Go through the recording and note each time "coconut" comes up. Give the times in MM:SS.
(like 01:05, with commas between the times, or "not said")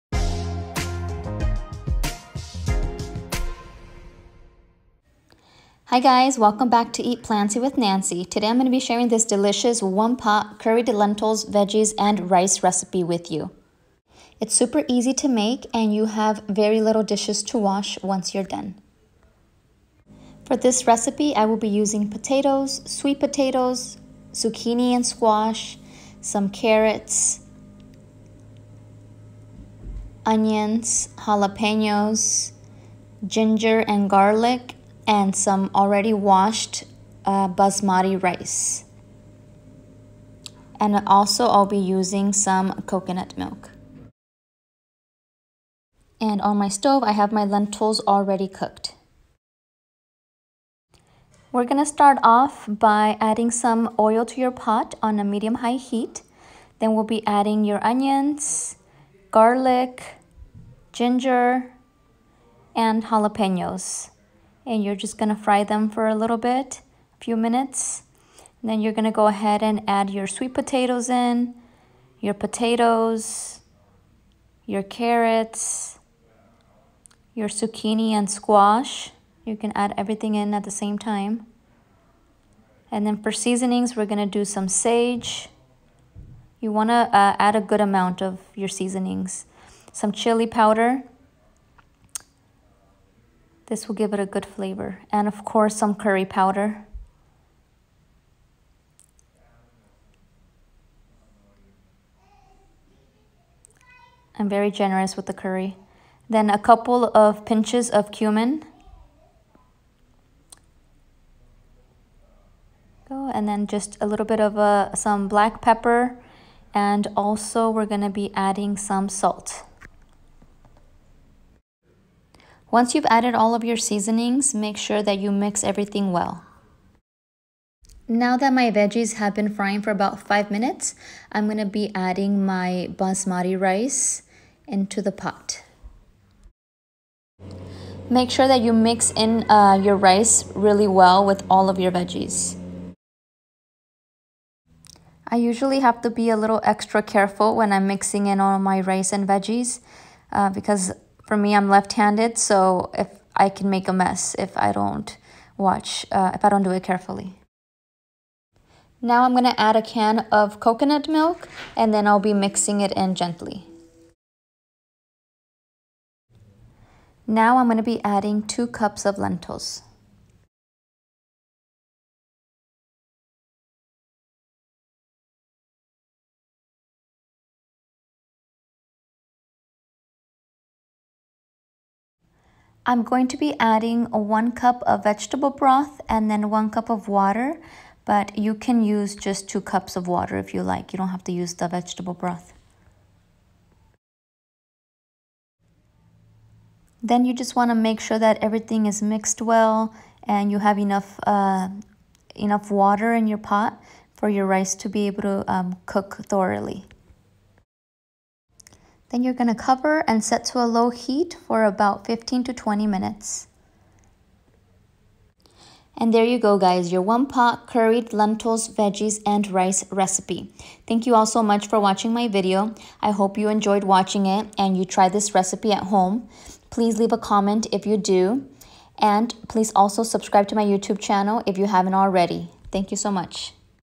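00:42, 02:40.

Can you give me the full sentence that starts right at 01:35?
And of course, some curry powder.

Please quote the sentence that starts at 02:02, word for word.
Once you've added all of your seasonings, make sure that you mix everything well.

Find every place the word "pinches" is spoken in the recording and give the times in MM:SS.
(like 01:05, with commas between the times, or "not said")
01:47.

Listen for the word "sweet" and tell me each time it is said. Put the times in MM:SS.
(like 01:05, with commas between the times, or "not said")
00:22, 01:10.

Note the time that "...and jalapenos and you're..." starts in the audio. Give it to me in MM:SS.
01:02.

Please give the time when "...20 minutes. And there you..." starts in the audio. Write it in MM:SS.
03:32.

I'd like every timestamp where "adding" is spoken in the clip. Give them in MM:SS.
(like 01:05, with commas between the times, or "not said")
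00:53, 00:57, 01:58, 02:11, 02:48, 03:03.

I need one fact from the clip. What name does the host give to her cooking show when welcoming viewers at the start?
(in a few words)
Eat Plantsy with Nancy.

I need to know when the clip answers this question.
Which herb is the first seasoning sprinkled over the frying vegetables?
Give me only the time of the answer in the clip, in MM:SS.
01:24.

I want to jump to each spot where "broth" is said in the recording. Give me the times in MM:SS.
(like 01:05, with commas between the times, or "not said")
03:05, 03:12.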